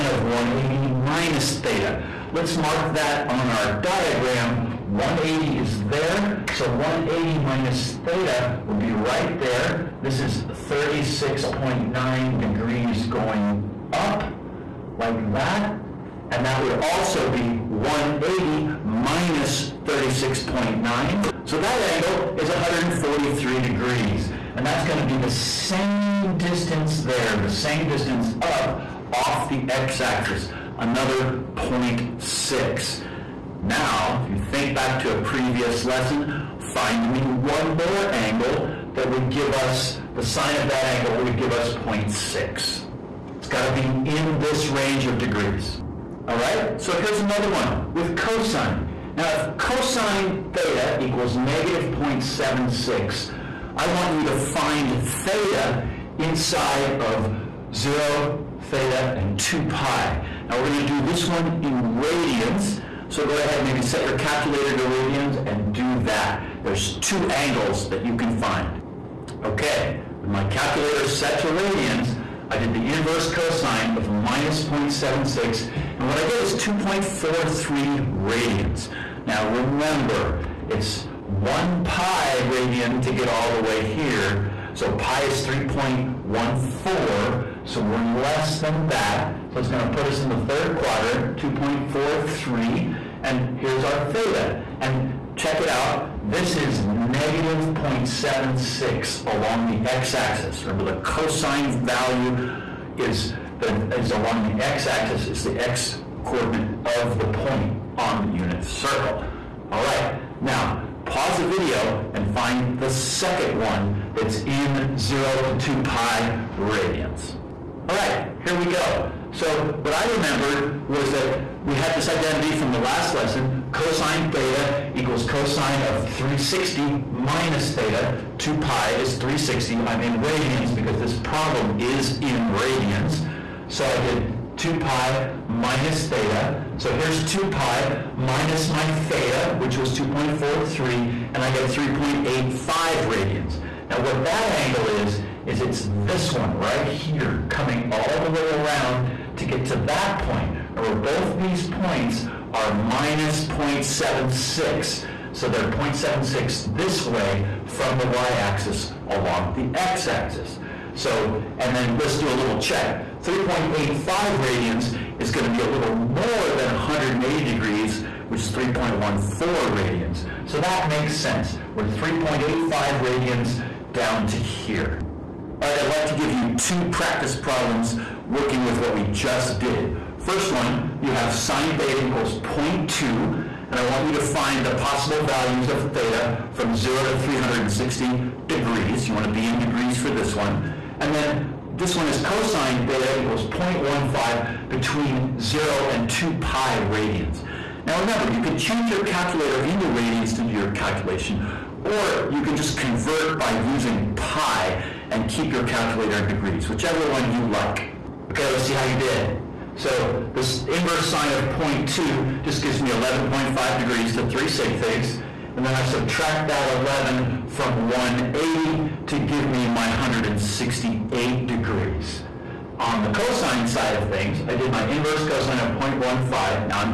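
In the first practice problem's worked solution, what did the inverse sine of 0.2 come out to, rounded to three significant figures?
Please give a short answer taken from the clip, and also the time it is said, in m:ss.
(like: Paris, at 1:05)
11.5 degrees, at 3:32.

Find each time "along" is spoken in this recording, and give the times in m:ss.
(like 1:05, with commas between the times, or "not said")
1:39, 1:44, 2:39.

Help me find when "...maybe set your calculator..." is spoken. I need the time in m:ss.
1:03.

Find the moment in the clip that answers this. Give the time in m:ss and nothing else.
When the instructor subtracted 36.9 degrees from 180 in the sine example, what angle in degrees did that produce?
0:22.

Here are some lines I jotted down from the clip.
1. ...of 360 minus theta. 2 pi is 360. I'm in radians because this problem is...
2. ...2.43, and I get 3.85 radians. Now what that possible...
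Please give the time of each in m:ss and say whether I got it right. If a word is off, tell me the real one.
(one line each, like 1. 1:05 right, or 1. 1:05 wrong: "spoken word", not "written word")
1. 2:05 right
2. 2:19 wrong: "angle", not "possible".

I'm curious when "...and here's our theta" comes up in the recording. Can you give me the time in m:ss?
1:33.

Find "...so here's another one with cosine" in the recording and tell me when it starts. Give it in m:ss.
0:46.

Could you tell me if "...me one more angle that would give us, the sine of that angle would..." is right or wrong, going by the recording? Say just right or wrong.
right.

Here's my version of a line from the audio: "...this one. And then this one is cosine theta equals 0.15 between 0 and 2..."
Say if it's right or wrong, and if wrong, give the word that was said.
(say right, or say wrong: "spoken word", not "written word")
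right.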